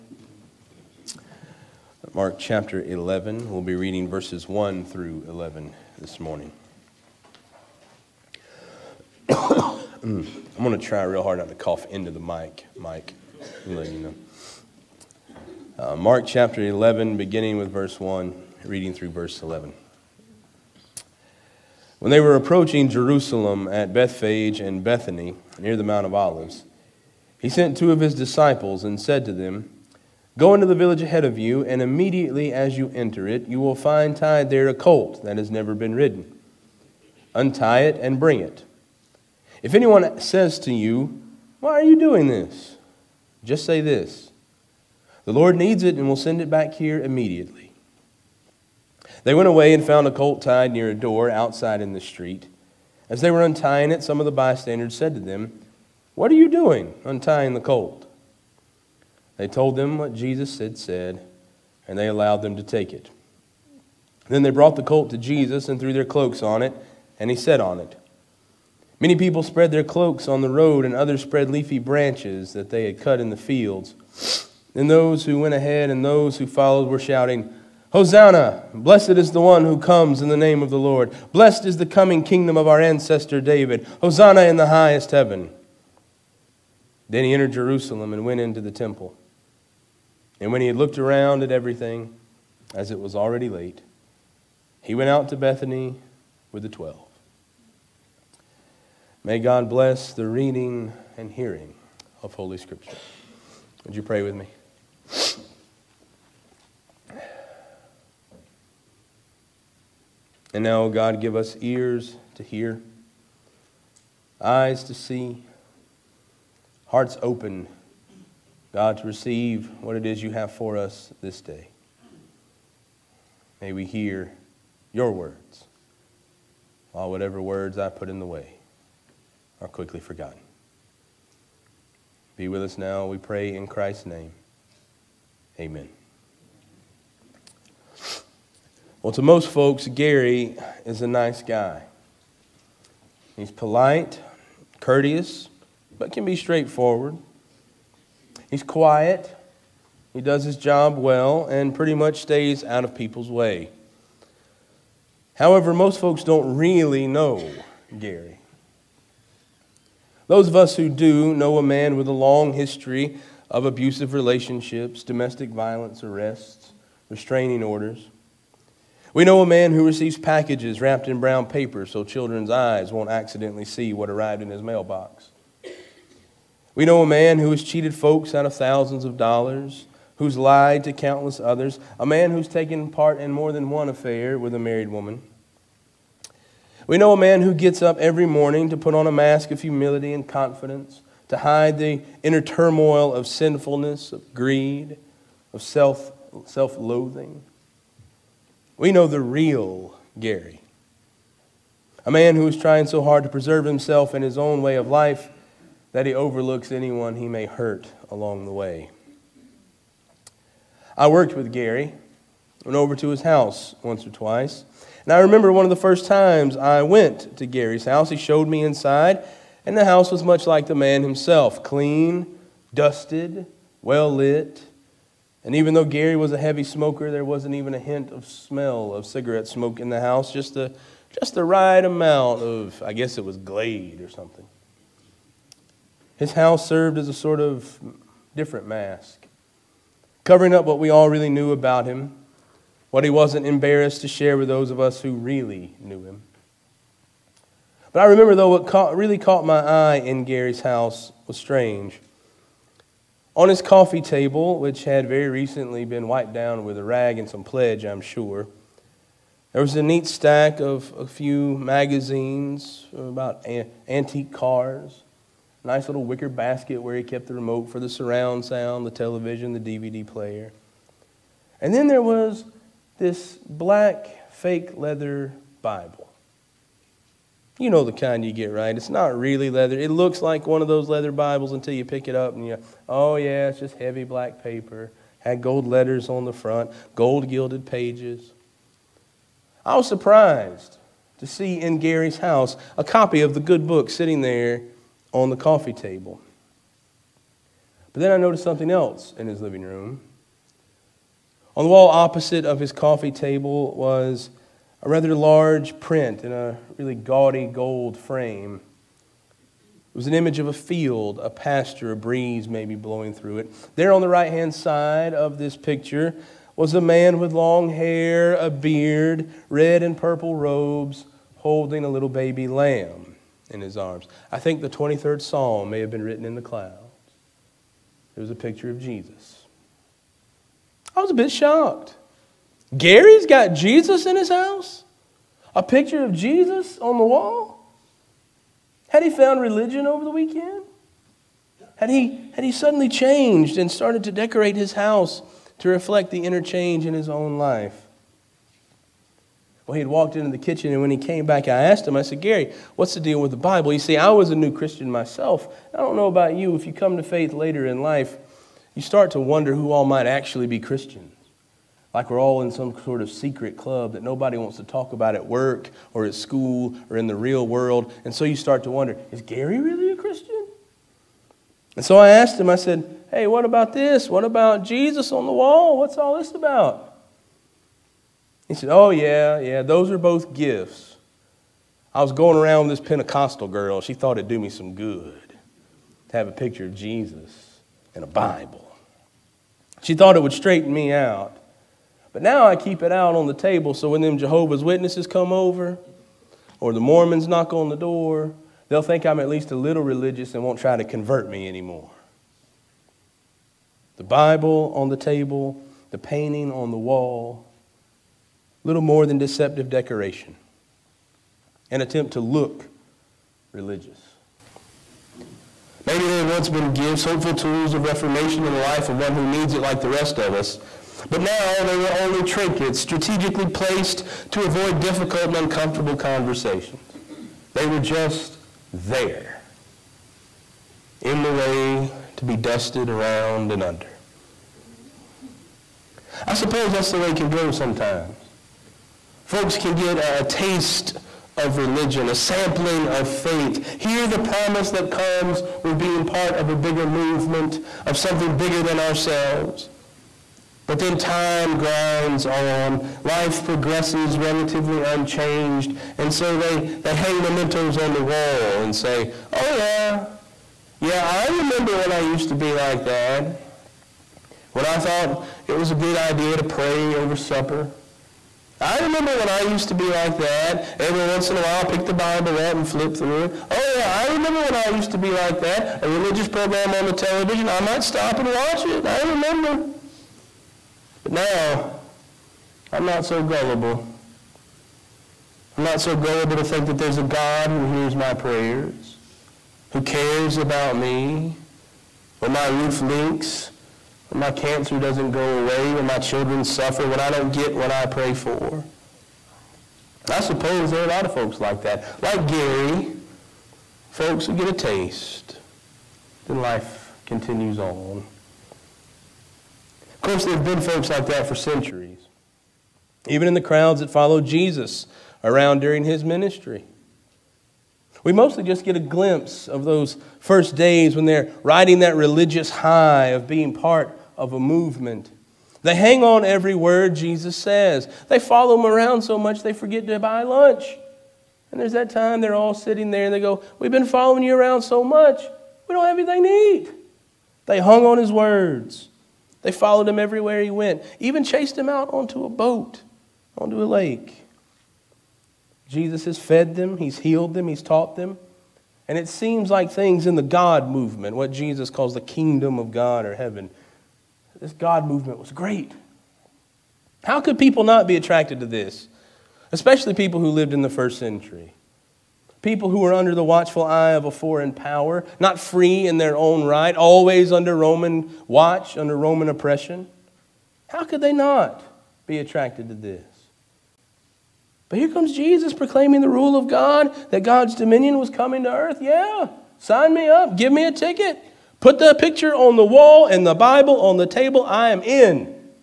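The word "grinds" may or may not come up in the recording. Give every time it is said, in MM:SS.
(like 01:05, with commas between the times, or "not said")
07:31.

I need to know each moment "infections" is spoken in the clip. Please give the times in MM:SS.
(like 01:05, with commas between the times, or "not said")
not said.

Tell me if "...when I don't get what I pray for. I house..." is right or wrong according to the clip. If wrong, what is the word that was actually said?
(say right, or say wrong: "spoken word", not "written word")
wrong: "suppose", not "house".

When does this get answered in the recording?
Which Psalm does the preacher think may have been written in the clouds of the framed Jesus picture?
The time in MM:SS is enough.
05:24.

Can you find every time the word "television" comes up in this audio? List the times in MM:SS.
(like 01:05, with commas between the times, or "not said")
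04:28, 07:56.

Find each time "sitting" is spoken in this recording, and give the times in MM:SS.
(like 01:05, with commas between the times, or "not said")
04:53, 08:52.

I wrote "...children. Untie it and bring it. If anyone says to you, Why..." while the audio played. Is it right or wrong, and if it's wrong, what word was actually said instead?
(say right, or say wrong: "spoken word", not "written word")
wrong: "ridden", not "children".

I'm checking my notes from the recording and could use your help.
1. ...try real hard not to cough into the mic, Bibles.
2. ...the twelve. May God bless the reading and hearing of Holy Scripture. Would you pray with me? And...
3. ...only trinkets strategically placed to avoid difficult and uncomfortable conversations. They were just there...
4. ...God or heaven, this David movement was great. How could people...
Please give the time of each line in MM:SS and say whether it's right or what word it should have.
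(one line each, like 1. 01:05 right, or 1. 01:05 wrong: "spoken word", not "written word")
1. 00:10 wrong: "Mike", not "Bibles"
2. 01:36 right
3. 07:01 right
4. 09:12 wrong: "God", not "David".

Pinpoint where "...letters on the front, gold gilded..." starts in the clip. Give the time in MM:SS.
04:45.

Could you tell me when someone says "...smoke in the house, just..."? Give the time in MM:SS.
03:49.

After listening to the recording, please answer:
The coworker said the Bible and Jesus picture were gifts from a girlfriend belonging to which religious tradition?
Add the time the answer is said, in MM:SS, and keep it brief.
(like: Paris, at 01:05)
Pentecostal, at 06:22.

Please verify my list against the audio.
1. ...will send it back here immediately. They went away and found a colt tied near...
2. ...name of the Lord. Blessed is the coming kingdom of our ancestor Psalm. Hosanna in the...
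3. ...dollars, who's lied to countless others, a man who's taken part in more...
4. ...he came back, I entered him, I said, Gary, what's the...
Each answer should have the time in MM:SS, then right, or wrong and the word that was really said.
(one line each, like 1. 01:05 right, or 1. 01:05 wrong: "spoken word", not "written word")
1. 00:46 right
2. 01:20 wrong: "David", not "Psalm"
3. 02:59 right
4. 05:50 wrong: "asked", not "entered".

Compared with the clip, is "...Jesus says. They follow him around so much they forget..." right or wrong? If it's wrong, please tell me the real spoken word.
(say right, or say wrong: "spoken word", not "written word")
right.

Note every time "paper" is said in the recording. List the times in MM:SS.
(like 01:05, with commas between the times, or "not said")
02:51, 04:44.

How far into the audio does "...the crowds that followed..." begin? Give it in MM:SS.
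08:33.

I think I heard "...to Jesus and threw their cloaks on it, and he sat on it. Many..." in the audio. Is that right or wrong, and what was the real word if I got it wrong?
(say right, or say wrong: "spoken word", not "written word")
right.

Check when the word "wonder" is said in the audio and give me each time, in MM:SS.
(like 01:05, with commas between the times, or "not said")
05:59, 06:08.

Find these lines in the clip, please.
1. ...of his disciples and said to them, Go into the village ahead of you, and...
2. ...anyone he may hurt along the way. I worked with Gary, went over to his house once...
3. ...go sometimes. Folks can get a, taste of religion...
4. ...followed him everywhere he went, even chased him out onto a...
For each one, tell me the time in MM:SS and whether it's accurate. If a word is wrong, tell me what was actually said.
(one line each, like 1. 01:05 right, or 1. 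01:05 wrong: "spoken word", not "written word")
1. 00:27 right
2. 03:26 right
3. 07:17 right
4. 08:59 right.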